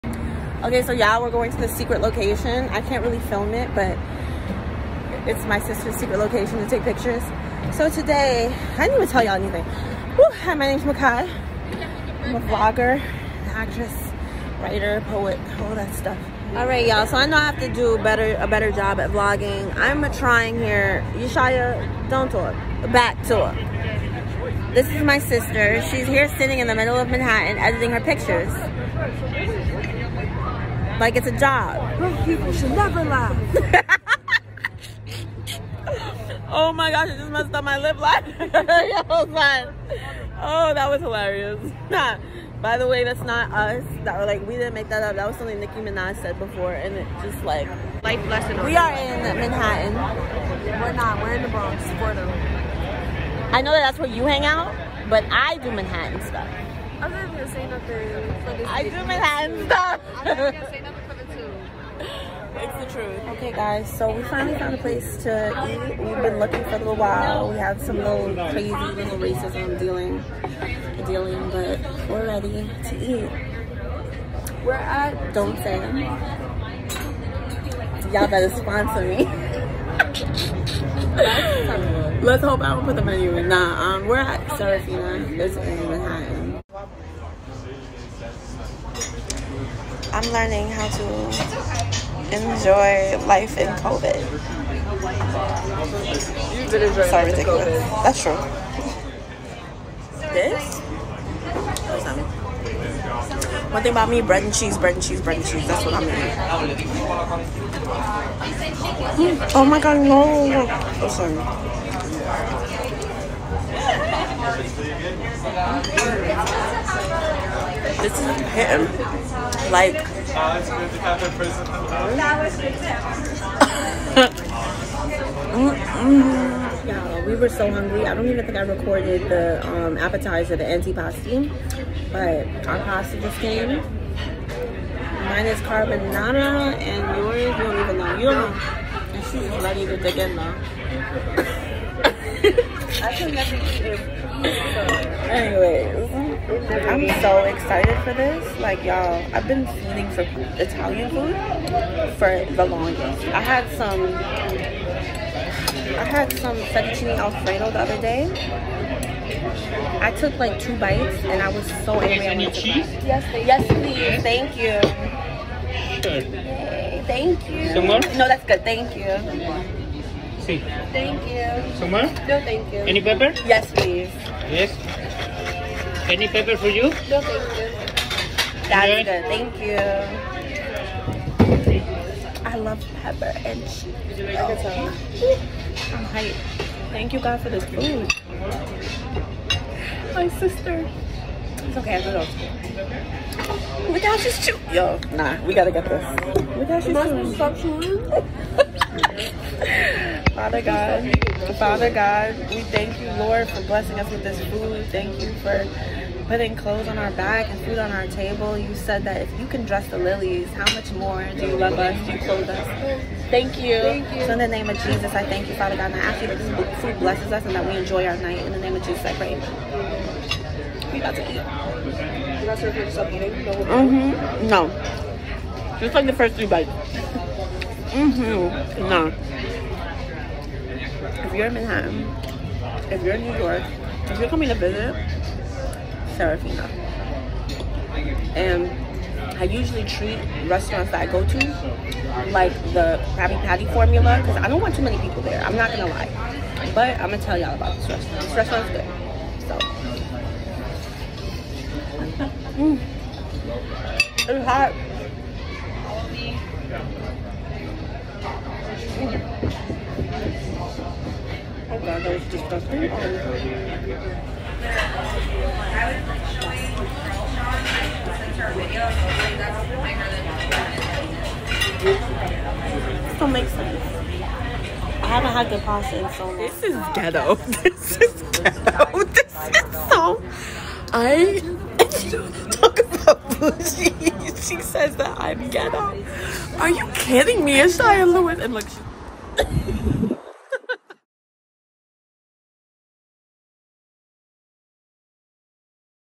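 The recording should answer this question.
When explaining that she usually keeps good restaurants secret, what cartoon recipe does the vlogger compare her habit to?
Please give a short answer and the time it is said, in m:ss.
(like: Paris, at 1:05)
Krabby Patty formula, at 4:03.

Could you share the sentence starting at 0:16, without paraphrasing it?
All right, y'all, so I know I have to do better a better job at vlogging.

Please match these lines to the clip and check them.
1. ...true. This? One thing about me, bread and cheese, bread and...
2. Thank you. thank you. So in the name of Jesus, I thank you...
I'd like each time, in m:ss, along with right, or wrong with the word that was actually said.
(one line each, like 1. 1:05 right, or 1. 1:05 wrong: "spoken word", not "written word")
1. 1:38 right
2. 3:33 right.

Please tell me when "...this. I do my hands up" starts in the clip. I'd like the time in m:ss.
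0:58.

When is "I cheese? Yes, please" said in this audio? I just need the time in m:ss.
2:42.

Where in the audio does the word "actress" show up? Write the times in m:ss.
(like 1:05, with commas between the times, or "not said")
0:13.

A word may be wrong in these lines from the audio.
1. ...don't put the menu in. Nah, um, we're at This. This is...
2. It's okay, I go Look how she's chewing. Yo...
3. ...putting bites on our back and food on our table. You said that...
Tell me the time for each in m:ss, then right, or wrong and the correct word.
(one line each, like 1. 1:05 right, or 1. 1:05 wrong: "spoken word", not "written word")
1. 1:22 wrong: "Serafina", not "This"
2. 3:11 right
3. 3:26 wrong: "clothes", not "bites".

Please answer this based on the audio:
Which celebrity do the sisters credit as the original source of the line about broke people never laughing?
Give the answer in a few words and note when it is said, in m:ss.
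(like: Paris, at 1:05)
Nicki Minaj, at 0:45.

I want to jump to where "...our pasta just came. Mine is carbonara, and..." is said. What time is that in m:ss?
2:12.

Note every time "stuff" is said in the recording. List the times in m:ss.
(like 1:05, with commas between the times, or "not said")
0:15, 0:56.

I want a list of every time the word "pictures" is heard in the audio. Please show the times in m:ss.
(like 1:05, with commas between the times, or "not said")
0:06, 0:28.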